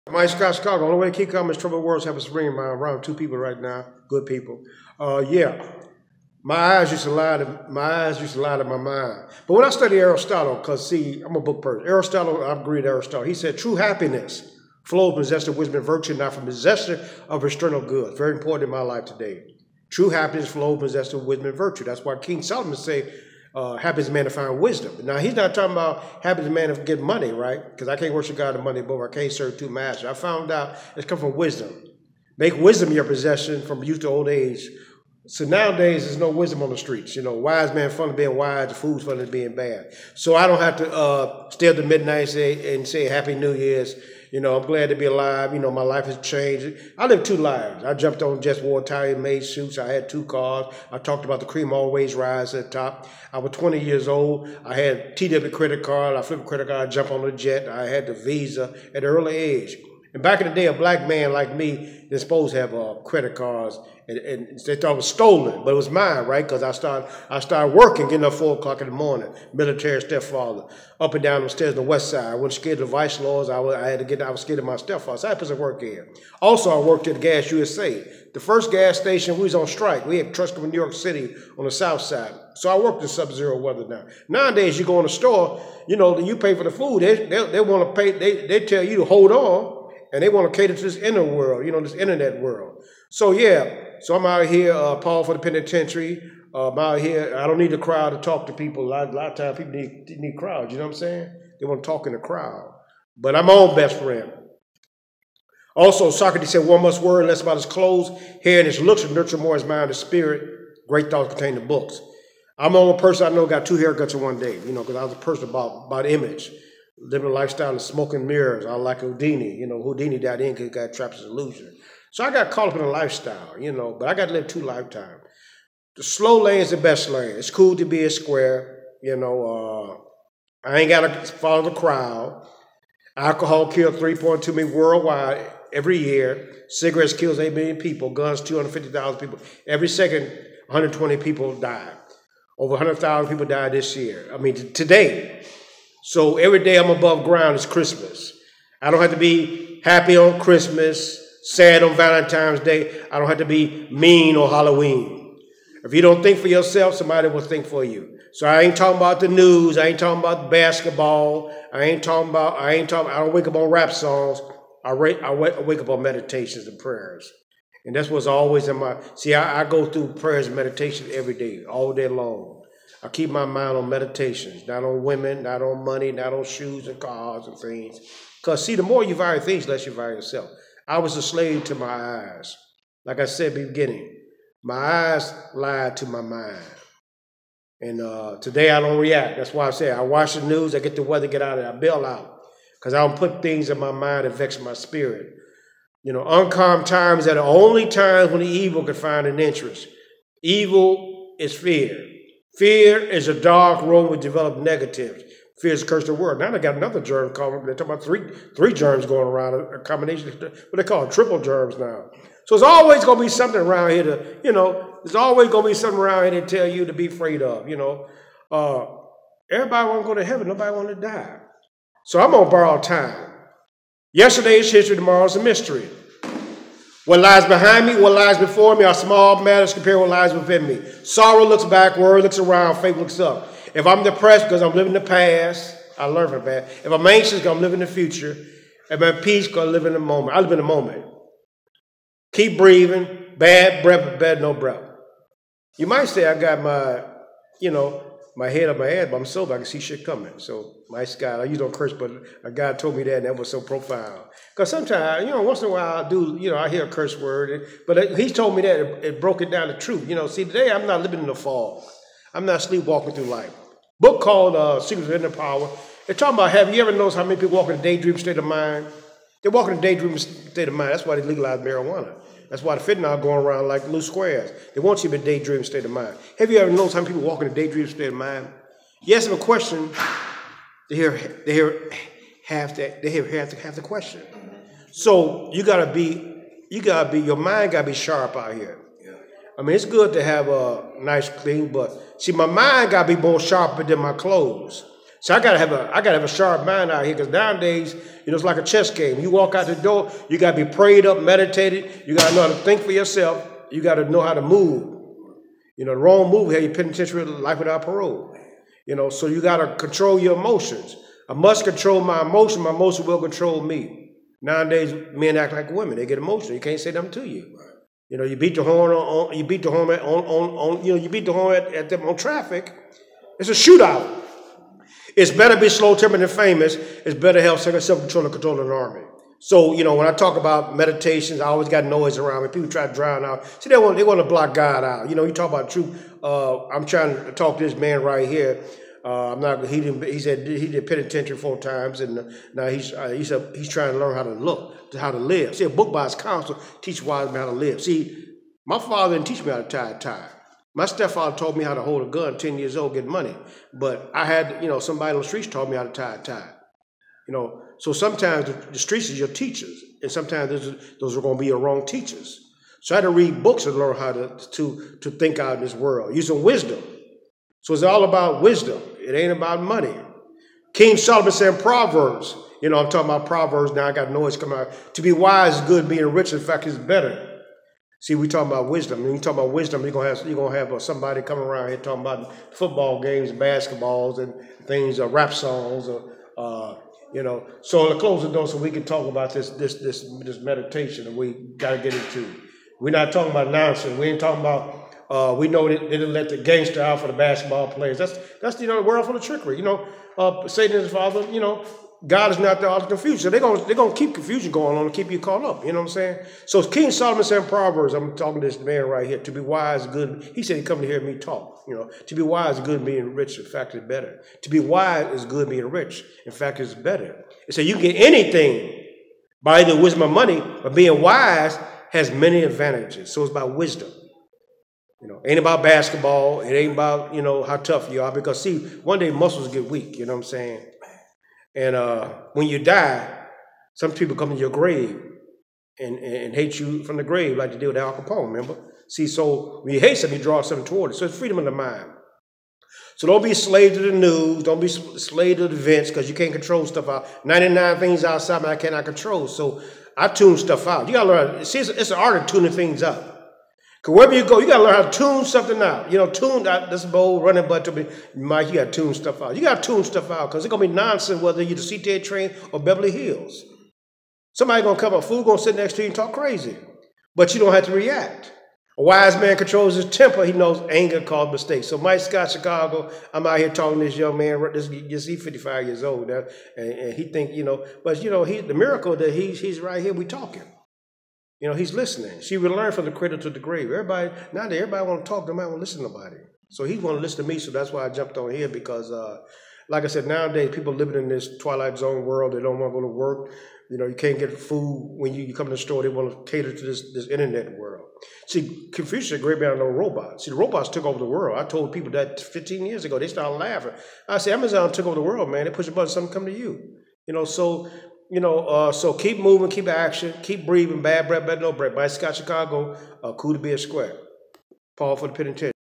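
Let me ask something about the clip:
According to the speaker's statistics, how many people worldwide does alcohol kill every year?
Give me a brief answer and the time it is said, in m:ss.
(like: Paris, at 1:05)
3.2 million, at 2:13.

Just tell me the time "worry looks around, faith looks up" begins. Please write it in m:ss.
3:51.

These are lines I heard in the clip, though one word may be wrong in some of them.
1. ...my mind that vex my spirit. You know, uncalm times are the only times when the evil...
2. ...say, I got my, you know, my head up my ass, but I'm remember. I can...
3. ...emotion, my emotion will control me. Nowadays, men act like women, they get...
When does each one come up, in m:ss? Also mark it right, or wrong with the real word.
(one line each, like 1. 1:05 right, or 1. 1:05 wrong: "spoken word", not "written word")
1. 3:13 right
2. 4:06 wrong: "sober", not "remember"
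3. 5:12 right.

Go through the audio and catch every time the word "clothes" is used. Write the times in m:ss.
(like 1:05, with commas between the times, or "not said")
1:47, 4:54.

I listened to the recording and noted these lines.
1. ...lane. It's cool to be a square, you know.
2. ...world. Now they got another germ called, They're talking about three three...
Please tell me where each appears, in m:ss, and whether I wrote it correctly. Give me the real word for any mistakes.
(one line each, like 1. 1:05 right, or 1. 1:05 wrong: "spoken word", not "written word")
1. 2:07 right
2. 3:26 right.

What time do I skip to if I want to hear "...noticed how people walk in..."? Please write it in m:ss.
4:36.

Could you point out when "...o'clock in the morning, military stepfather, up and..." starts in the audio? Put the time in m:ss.
1:08.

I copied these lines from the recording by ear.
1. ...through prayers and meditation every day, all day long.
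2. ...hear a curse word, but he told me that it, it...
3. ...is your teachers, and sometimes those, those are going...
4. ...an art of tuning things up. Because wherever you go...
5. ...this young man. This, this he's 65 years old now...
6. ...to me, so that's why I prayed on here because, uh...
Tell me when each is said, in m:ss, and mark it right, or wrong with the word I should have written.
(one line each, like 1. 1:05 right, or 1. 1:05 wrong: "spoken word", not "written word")
1. 2:49 right
2. 4:16 right
3. 5:59 right
4. 7:31 right
5. 7:53 wrong: "55", not "65"
6. 8:07 wrong: "jumped", not "prayed".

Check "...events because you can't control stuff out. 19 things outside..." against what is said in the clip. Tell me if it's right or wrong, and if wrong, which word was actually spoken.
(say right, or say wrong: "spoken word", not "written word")
wrong: "99", not "19".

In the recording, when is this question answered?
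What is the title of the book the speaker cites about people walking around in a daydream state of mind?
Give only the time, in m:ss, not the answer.
4:24.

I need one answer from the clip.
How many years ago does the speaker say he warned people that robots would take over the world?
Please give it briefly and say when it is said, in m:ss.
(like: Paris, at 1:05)
15, at 8:22.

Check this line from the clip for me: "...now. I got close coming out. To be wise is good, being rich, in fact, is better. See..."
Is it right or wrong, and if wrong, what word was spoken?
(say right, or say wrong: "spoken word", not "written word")
wrong: "noise", not "close".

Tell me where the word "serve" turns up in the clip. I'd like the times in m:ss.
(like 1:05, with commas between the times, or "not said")
0:29.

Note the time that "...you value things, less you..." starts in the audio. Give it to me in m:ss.
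2:59.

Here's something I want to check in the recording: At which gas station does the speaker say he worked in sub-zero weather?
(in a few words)
Gas USA.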